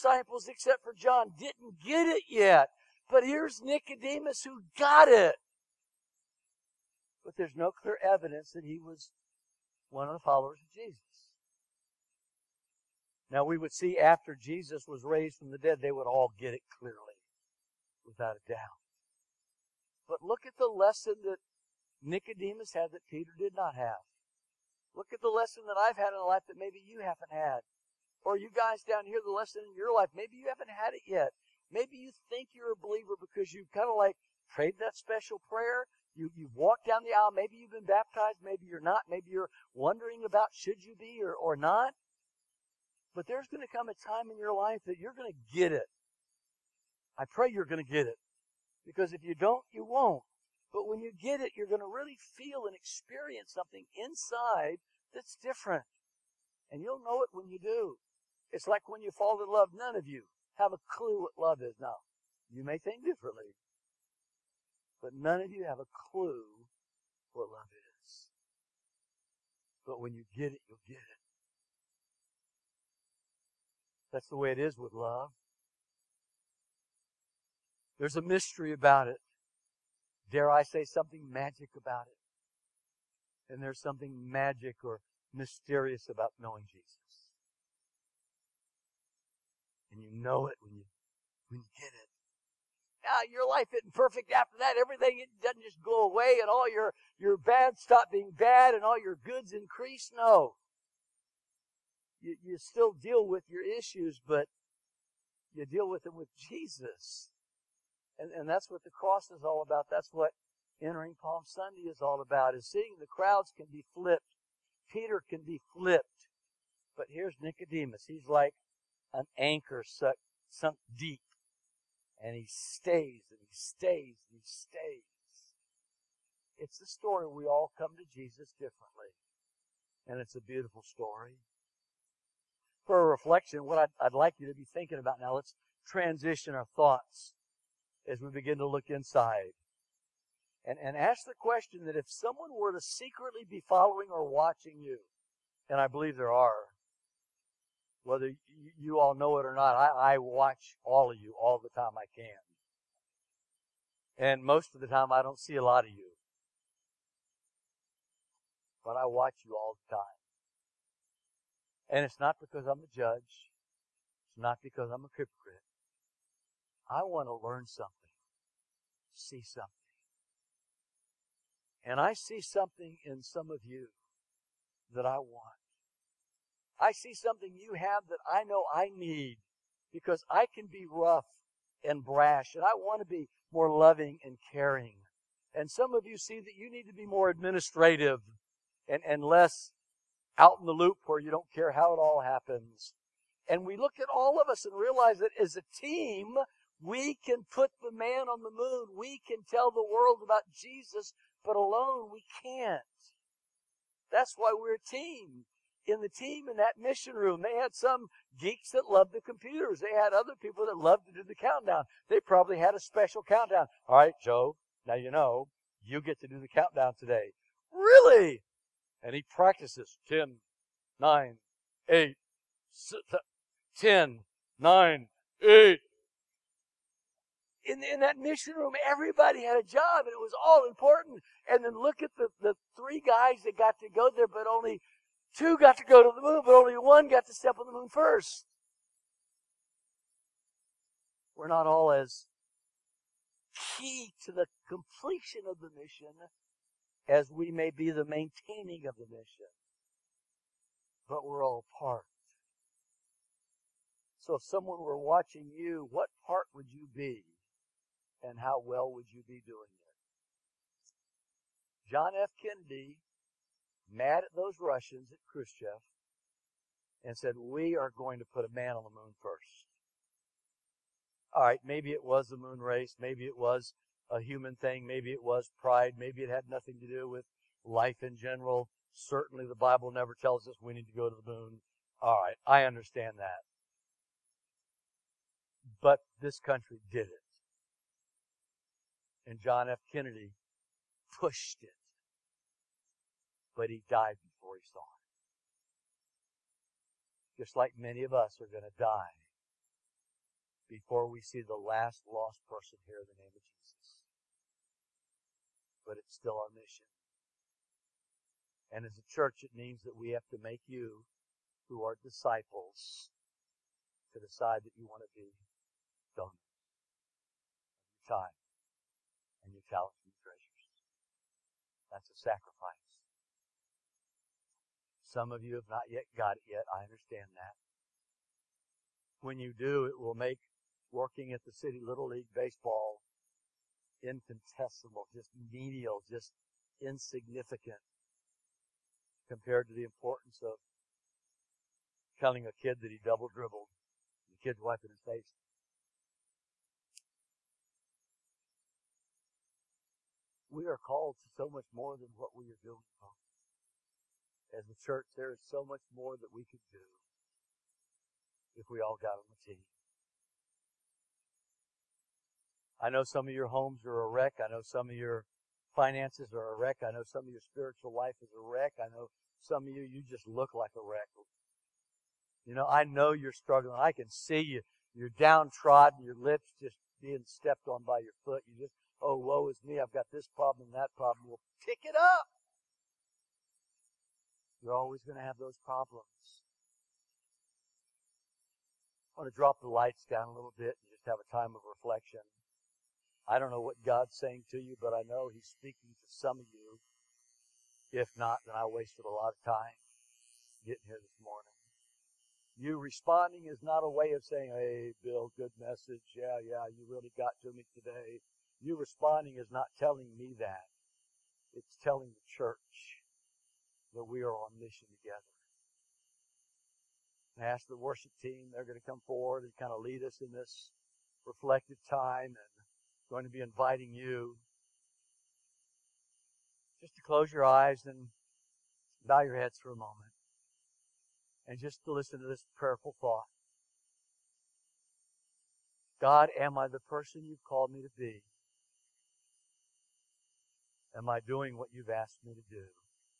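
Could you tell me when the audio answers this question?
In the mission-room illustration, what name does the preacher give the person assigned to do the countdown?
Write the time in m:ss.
3:34.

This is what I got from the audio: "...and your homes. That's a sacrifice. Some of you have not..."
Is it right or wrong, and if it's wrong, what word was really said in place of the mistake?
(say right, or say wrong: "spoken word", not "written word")
wrong: "treasures", not "homes".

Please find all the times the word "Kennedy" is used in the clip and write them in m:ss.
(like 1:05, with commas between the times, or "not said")
4:22, 4:49.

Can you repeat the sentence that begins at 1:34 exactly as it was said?
Everything it doesn't just go away, and all your your bad stop being bad, and all your goods increase.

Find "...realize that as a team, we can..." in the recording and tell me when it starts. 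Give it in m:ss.
3:14.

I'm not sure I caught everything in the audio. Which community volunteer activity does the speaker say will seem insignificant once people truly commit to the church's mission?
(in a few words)
City Little League Baseball.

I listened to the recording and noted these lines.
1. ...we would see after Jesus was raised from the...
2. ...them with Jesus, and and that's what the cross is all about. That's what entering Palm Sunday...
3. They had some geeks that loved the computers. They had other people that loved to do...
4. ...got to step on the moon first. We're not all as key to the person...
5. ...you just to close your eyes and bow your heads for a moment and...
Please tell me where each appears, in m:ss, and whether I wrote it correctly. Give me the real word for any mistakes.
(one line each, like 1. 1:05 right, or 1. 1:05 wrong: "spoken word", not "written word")
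1. 0:13 right
2. 1:46 right
3. 3:27 right
4. 3:57 wrong: "completion", not "person"
5. 7:03 right.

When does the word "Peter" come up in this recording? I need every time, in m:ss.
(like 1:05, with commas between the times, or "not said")
0:23, 1:54.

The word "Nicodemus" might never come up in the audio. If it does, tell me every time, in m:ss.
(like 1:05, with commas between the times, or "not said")
0:03, 0:22, 1:57.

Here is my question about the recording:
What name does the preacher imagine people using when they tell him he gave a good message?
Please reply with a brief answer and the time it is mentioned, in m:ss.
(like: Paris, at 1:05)
Bill, at 6:45.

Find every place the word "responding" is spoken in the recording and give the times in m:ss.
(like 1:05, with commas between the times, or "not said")
6:42, 6:48.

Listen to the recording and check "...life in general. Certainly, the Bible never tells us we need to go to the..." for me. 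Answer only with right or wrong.
right.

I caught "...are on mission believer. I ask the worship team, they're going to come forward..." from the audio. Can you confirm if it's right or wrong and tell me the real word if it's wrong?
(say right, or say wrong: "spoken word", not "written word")
wrong: "together", not "believer".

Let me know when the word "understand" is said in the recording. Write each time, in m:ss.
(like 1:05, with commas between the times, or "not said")
4:42, 5:26.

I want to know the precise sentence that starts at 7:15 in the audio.
God, am I the person you've called me to be?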